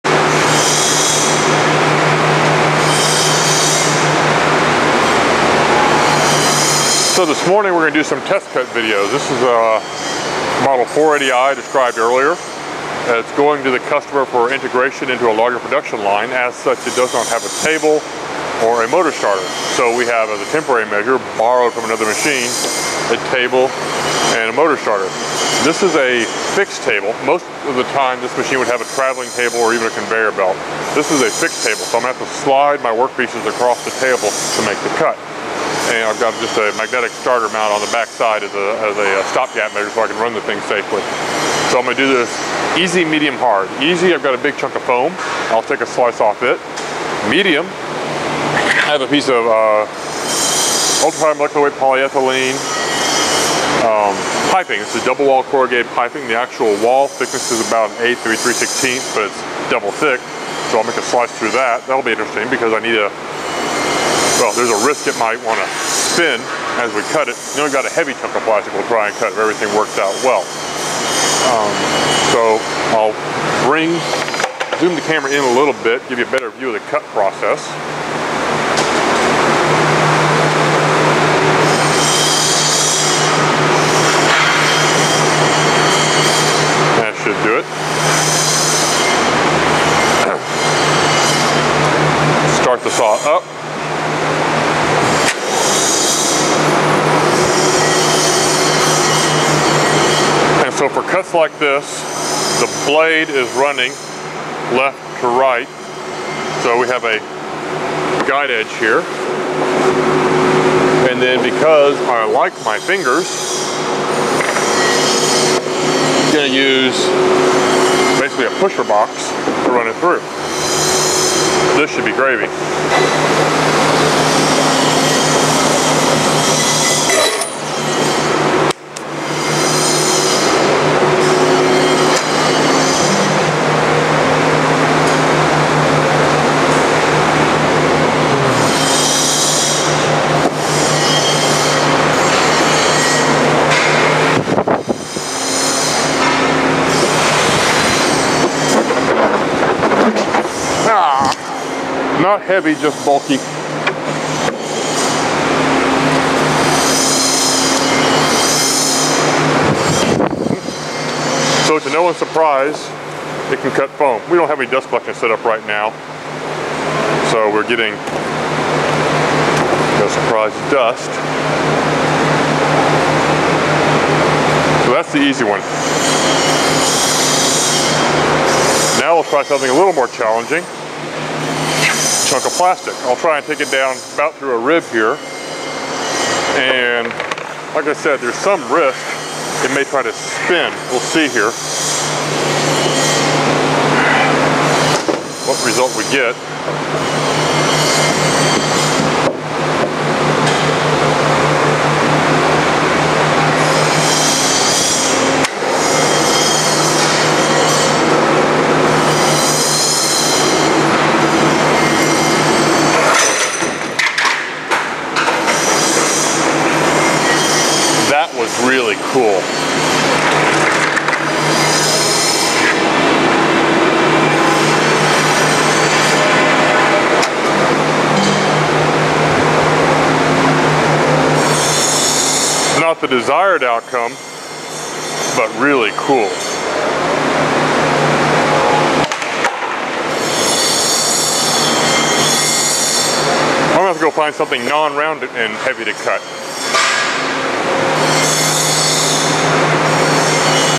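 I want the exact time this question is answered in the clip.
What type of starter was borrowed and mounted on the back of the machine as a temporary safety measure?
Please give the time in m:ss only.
0:36.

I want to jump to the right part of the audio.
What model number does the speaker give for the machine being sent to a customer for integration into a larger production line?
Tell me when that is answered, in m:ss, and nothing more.
0:10.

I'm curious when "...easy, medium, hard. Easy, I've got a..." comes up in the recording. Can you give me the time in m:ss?
0:42.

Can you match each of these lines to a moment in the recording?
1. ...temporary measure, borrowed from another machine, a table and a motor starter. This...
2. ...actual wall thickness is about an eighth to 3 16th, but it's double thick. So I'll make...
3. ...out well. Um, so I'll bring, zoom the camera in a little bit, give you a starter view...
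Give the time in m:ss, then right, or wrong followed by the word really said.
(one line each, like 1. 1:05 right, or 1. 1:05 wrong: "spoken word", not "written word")
1. 0:20 right
2. 0:56 right
3. 1:10 wrong: "better", not "starter".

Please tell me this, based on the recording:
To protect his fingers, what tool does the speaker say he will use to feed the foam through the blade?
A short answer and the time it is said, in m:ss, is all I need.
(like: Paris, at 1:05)
Pusher box, at 1:58.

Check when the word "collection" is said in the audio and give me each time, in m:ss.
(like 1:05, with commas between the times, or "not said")
2:44.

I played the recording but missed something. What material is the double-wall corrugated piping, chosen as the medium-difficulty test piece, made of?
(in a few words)
Ultra-high molecular weight polyethylene.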